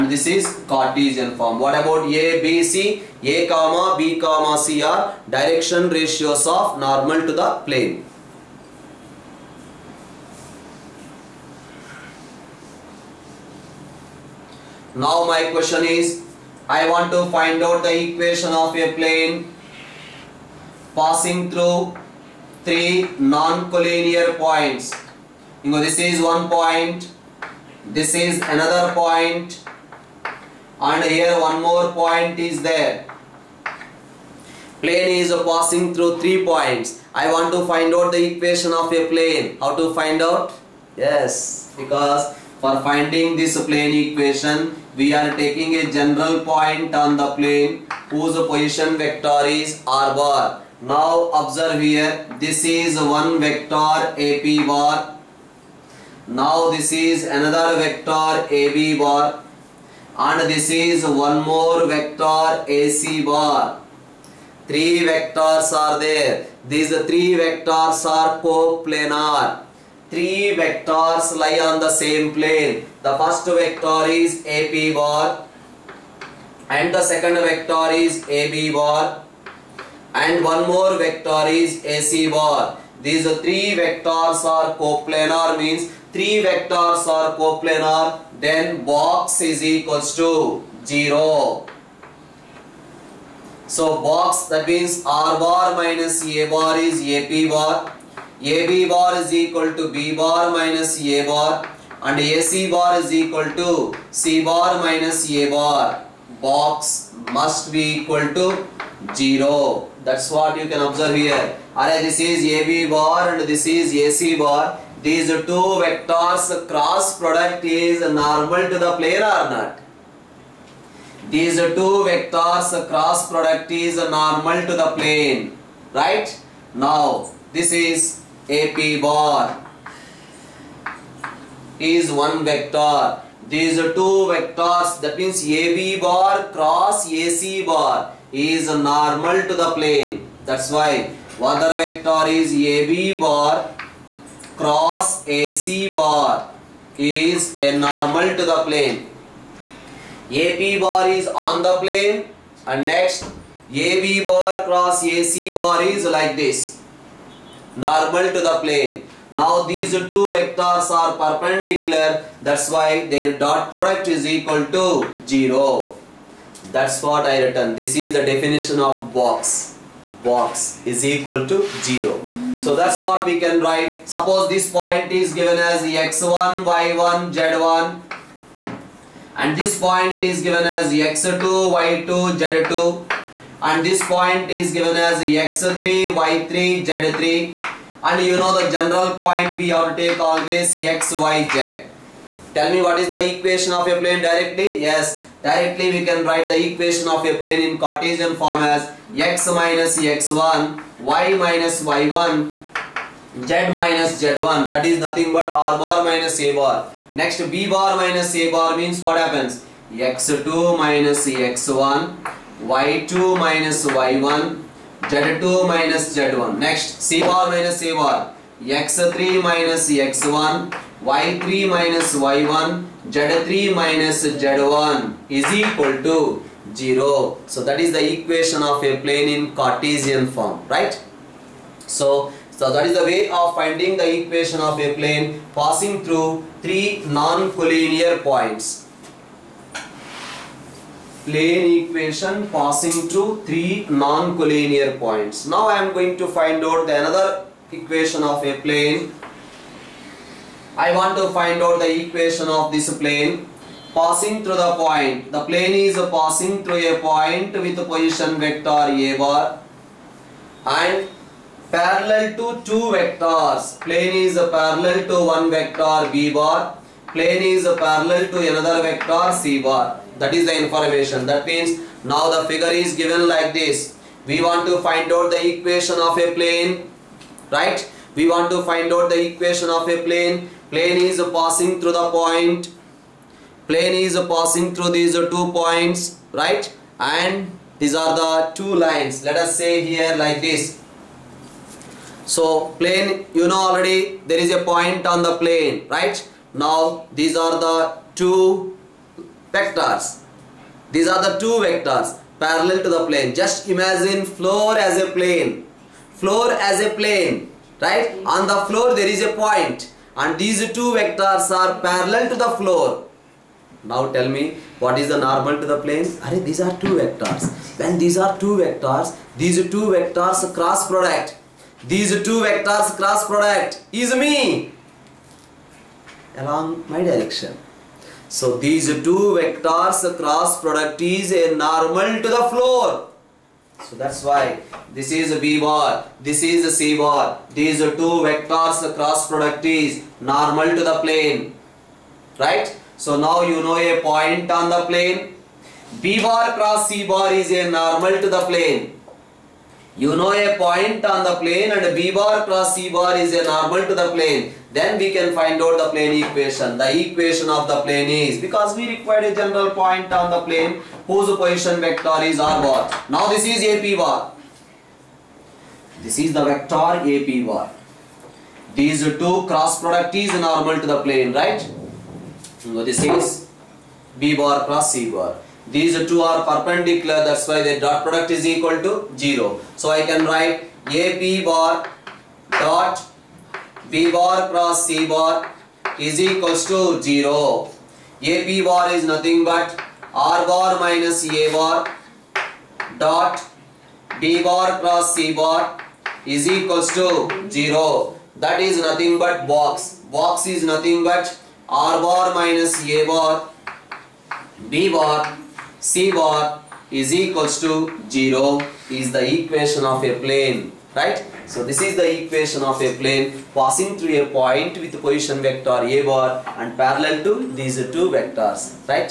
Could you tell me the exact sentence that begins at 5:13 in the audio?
Now tell me what is the normal to the plane?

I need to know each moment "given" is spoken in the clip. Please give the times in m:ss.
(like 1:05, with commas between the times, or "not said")
2:55, 3:00, 3:04, 4:32.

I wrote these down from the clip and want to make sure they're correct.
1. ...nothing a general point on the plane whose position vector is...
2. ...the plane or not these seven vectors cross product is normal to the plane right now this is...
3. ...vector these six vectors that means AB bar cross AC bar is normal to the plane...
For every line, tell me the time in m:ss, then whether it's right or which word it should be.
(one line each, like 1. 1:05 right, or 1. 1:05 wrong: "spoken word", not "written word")
1. 0:45 wrong: "taking", not "nothing"
2. 1:58 wrong: "two", not "seven"
3. 2:12 wrong: "two", not "six".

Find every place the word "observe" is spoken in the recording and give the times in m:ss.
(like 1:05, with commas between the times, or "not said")
0:51, 1:50.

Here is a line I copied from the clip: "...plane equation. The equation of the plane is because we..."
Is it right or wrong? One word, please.
right.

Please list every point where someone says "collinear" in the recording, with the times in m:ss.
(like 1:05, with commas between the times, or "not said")
0:23, 3:57, 4:03.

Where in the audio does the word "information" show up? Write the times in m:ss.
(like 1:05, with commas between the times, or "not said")
4:30.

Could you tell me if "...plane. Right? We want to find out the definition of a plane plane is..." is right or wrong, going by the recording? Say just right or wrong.
wrong.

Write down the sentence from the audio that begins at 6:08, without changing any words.
These two cross product is normal to the plane, right?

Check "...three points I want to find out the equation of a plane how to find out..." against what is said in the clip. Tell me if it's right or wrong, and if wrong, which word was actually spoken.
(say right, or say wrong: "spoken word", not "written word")
right.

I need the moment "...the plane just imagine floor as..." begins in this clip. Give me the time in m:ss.
5:02.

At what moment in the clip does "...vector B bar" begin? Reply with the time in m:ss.
4:25.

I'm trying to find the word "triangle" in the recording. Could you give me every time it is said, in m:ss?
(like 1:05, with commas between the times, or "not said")
not said.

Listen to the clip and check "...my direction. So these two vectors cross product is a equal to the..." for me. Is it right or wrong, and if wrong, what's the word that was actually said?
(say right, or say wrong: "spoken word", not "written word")
wrong: "normal", not "equal".